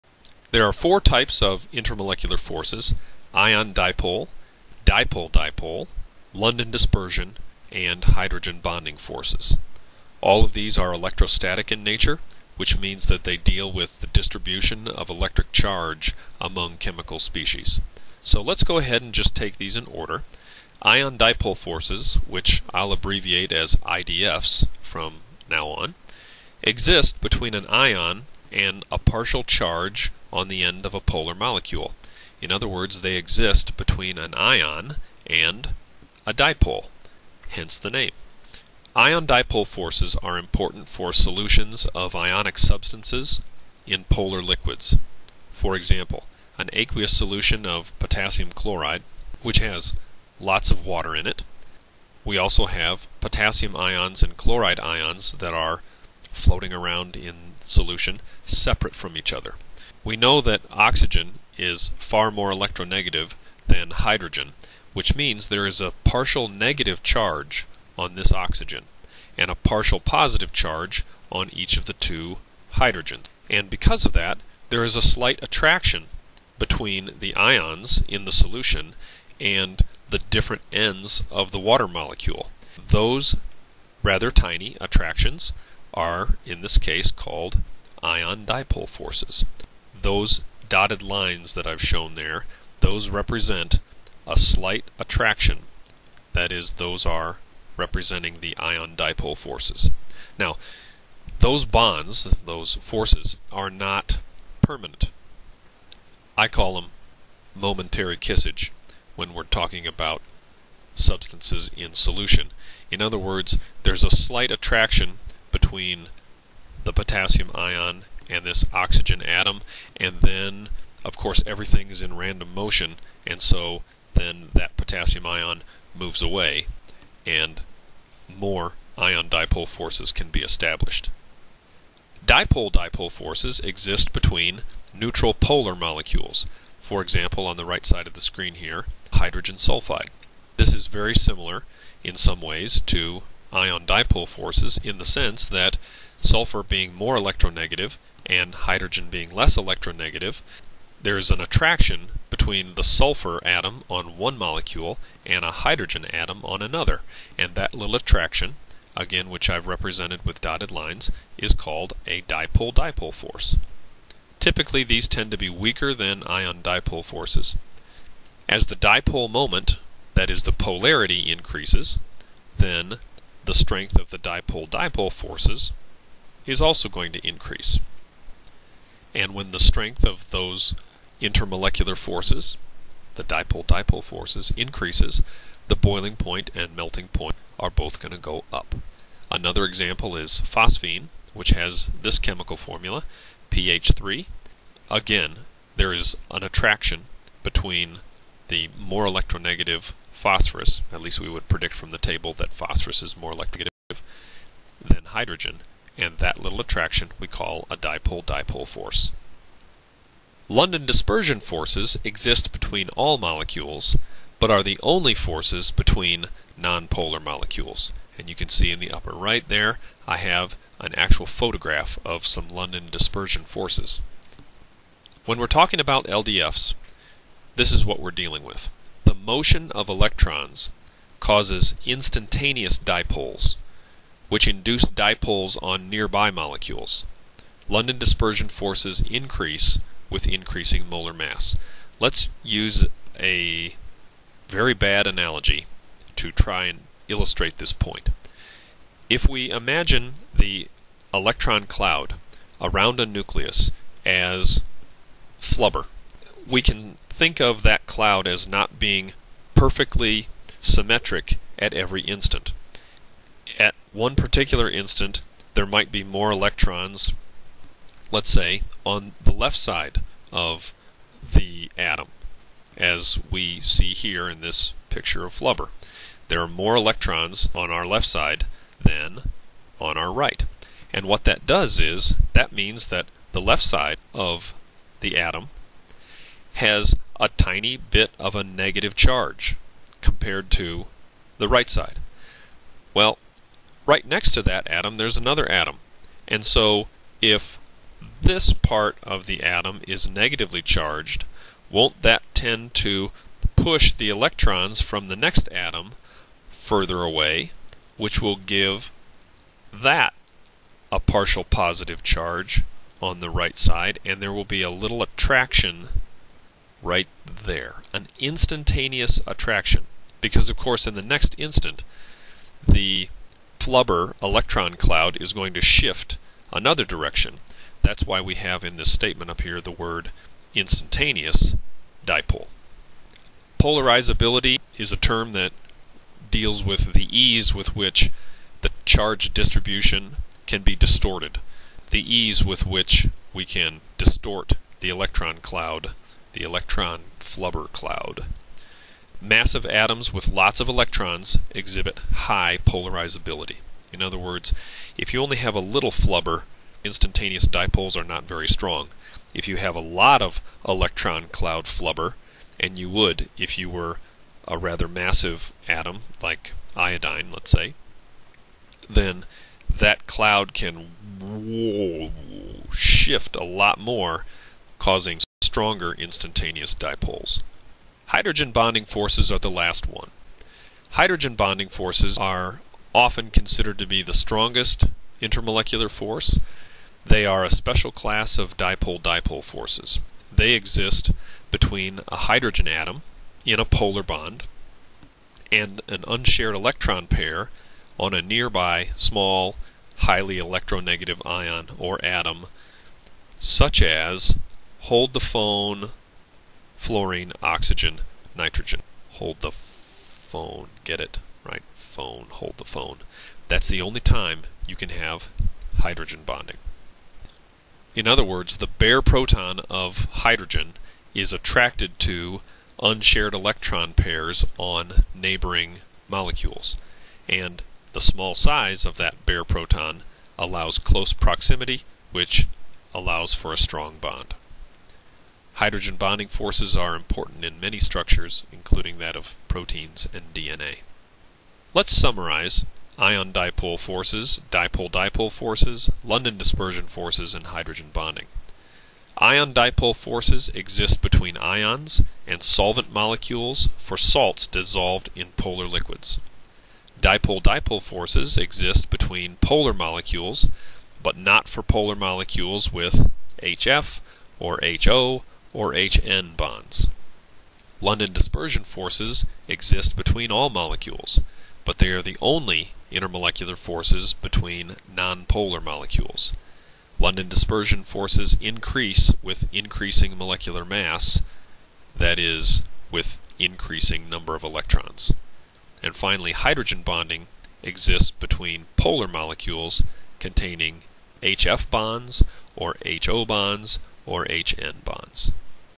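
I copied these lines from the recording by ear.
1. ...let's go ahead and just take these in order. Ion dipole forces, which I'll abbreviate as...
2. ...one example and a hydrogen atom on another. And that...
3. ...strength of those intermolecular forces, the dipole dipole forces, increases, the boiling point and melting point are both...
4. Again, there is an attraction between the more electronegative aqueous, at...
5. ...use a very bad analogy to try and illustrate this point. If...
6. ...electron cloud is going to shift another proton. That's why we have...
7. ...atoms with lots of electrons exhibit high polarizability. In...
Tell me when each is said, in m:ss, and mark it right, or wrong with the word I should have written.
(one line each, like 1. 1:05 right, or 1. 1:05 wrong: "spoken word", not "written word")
1. 0:18 right
2. 2:34 wrong: "molecule", not "example"
3. 2:59 right
4. 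3:14 wrong: "phosphorus", not "aqueous"
5. 4:02 right
6. 5:24 wrong: "direction", not "proton"
7. 5:49 right.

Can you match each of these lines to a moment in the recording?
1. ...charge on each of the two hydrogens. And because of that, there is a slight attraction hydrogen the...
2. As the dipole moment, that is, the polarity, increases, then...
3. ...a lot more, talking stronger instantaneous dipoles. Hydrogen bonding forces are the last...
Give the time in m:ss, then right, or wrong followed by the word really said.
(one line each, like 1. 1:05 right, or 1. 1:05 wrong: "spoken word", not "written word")
1. 1:10 wrong: "between", not "hydrogen"
2. 2:48 right
3. 6:13 wrong: "causing", not "talking".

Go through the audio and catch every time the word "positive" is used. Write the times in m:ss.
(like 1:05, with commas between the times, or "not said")
1:09, 5:11.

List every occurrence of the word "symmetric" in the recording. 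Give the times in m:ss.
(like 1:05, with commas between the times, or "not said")
4:20.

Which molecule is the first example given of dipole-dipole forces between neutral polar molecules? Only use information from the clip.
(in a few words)
hydrogen sulfide.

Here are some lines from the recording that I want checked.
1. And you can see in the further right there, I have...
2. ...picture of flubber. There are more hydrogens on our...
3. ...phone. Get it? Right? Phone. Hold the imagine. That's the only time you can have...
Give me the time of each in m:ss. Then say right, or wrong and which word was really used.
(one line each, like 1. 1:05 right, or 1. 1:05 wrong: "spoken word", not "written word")
1. 3:38 wrong: "upper", not "further"
2. 4:34 wrong: "electrons", not "hydrogens"
3. 6:49 wrong: "phone", not "imagine".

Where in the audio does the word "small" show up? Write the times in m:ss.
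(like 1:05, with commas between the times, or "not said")
6:38, 7:08.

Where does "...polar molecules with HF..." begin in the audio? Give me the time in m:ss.
7:41.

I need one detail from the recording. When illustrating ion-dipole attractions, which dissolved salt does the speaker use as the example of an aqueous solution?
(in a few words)
potassium chloride.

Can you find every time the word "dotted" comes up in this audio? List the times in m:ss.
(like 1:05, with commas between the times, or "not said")
1:30, 2:40.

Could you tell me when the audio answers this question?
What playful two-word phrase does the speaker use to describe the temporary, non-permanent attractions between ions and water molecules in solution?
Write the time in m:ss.
1:47.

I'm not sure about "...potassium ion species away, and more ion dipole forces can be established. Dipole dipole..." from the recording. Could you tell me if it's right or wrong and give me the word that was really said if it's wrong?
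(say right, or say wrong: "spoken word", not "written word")
wrong: "moves", not "species".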